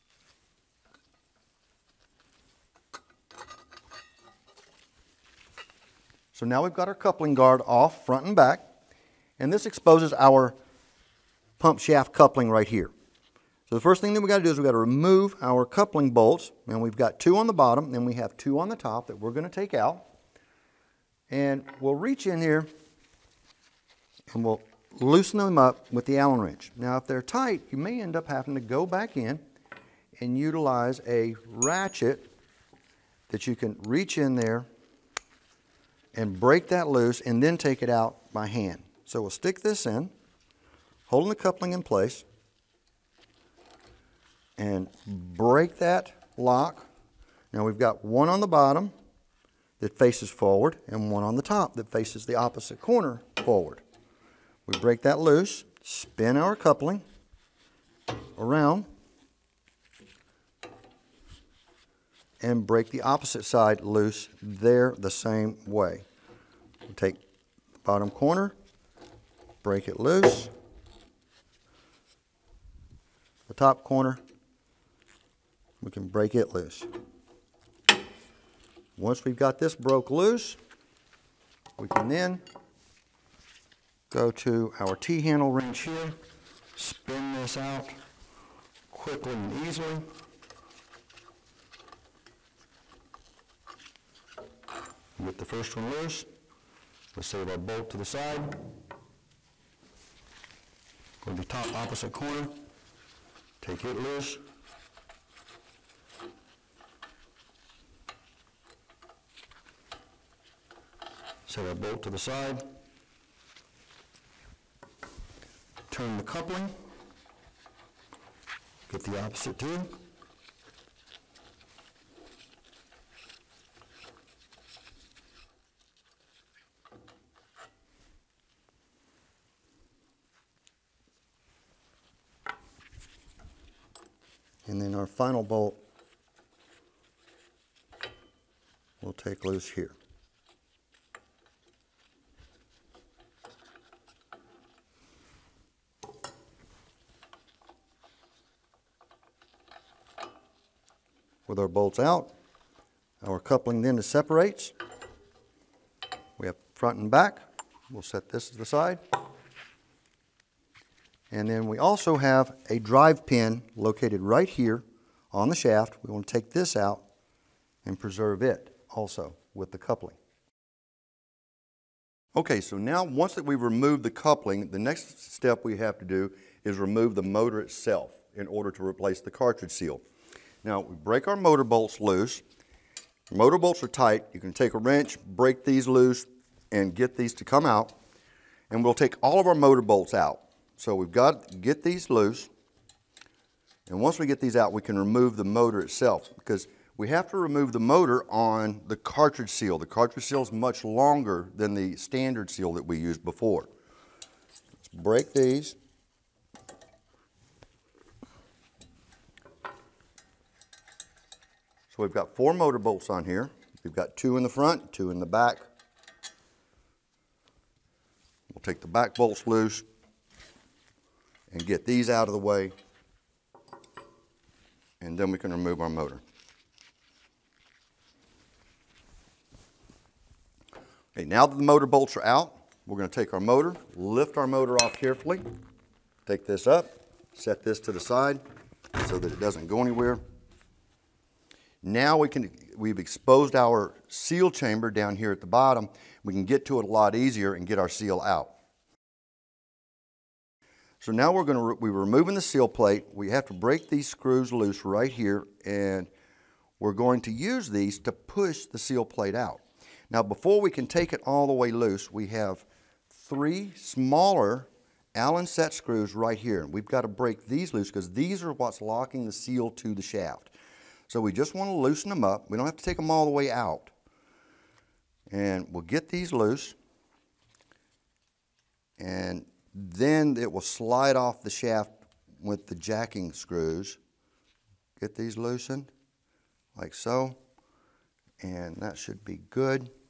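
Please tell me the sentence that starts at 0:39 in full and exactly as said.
So we'll stick this in, holding the coupling in place, and break that lock.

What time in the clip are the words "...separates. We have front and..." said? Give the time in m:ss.
2:34.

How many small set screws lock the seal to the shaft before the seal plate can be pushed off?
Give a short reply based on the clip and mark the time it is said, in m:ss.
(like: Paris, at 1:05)
3, at 4:23.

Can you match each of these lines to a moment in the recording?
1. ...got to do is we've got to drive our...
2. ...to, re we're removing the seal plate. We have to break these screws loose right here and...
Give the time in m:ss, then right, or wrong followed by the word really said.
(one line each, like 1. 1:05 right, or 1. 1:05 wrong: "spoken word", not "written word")
1. 0:14 wrong: "remove", not "drive"
2. 4:11 right.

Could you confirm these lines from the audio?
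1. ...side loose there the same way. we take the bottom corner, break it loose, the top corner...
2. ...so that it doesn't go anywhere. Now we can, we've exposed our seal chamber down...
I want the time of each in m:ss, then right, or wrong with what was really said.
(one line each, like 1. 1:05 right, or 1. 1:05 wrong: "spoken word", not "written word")
1. 1:03 right
2. 3:59 right.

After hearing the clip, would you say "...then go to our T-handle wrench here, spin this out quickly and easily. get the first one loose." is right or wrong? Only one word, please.
right.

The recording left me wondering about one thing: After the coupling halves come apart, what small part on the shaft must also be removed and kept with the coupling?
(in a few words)
drive pin.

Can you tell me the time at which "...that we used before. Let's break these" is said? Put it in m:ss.
3:22.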